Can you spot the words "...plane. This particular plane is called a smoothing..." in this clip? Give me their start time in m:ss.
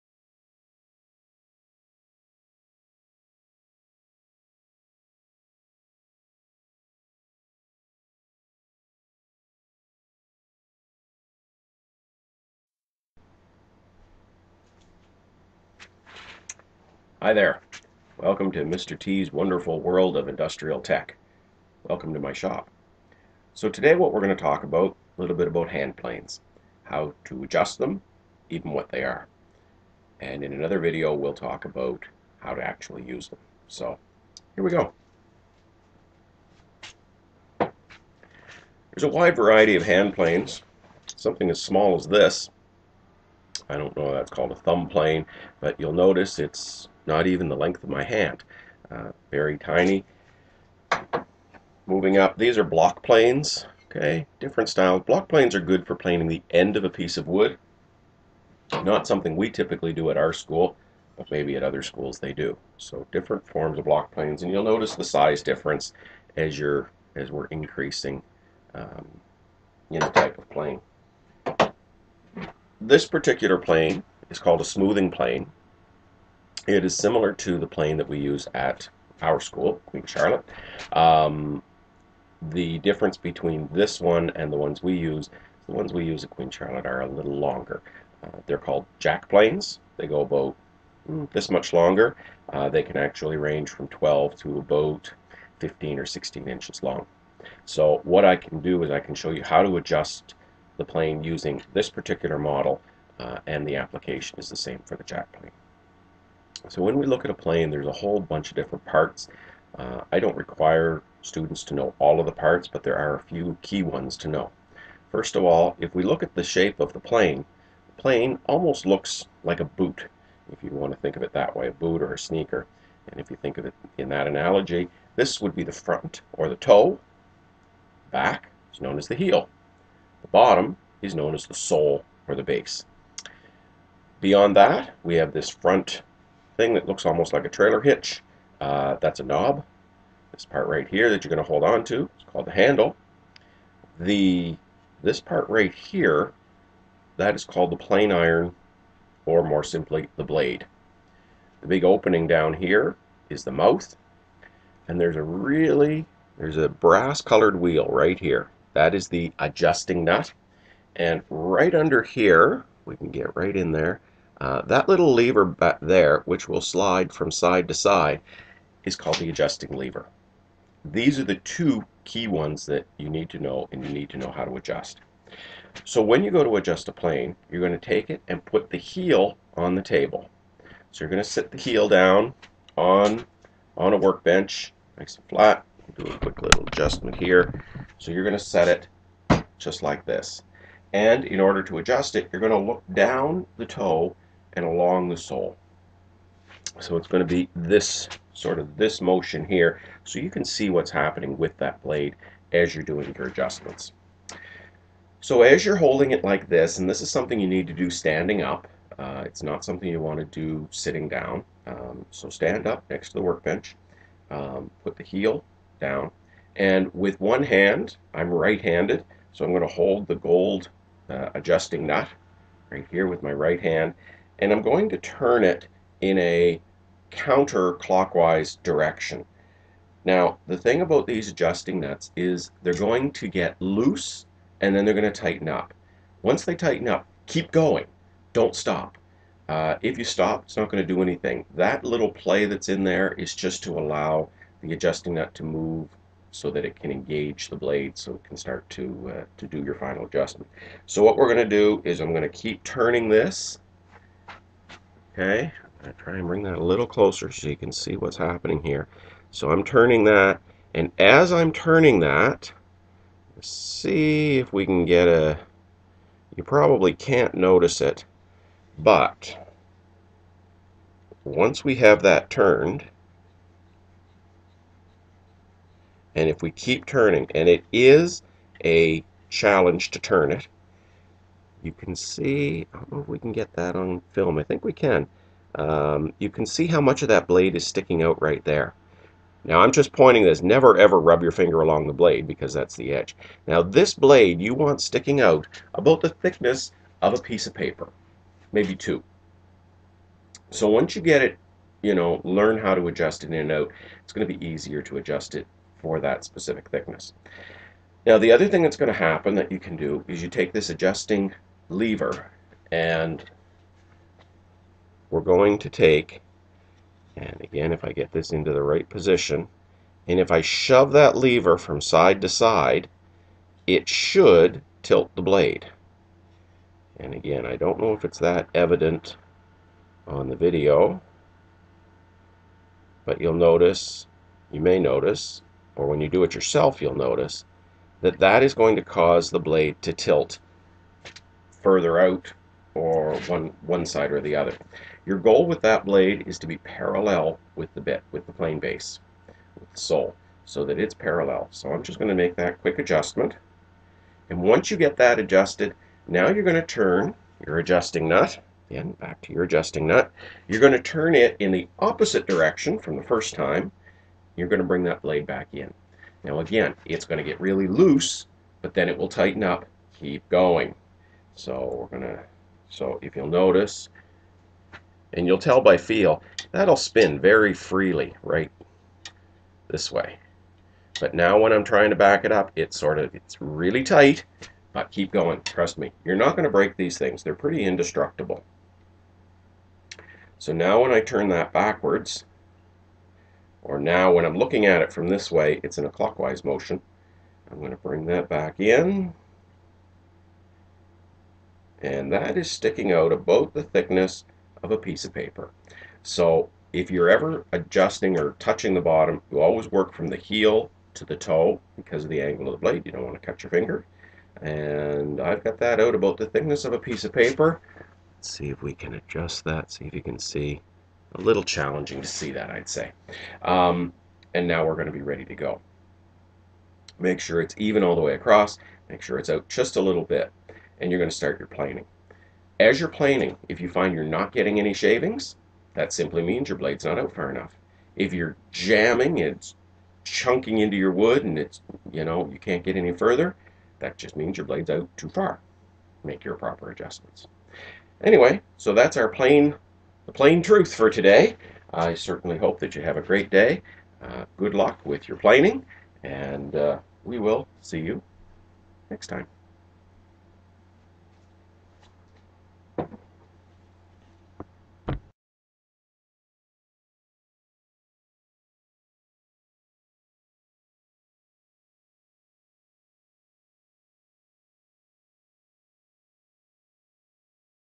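1:10.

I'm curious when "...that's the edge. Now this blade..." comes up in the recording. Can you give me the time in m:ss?
4:52.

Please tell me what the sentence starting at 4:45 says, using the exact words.
Um, you can see how much of that blade is sticking out right there.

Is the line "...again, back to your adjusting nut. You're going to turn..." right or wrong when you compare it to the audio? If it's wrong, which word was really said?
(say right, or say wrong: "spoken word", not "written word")
right.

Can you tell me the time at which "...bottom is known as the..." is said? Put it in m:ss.
2:10.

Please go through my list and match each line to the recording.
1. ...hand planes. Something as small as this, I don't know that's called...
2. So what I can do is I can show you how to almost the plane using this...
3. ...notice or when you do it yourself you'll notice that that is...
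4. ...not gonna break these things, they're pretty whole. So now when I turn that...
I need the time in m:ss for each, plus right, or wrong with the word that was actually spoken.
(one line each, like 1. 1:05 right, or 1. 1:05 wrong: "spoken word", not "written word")
1. 0:39 right
2. 1:37 wrong: "adjust", not "almost"
3. 5:34 right
4. 6:26 wrong: "indestructible", not "whole".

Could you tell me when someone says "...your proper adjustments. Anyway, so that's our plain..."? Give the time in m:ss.
7:26.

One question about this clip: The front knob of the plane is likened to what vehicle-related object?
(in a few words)
A trailer hitch.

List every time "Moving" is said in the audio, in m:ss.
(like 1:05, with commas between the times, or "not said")
0:51.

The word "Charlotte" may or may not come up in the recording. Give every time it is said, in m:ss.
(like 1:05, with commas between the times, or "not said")
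1:20, 1:26.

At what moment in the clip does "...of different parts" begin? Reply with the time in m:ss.
1:48.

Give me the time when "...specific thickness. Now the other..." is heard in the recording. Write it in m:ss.
5:06.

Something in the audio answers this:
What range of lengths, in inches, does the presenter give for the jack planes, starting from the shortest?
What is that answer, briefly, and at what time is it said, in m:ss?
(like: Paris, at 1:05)
12 to 15 or 16 inches, at 1:33.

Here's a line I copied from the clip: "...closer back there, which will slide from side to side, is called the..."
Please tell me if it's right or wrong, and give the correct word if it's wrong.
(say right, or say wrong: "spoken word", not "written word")
wrong: "lever", not "closer".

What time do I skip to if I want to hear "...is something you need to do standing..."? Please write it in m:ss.
3:27.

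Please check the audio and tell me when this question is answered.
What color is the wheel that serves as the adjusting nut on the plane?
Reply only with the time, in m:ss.
2:36.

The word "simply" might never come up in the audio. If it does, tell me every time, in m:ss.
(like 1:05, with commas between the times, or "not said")
2:29, 7:15.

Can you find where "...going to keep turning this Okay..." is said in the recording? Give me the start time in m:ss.
4:12.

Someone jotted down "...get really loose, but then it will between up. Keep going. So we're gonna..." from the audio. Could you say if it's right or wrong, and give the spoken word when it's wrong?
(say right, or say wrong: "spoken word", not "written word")
wrong: "tighten", not "between".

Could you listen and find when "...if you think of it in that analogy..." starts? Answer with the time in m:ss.
2:03.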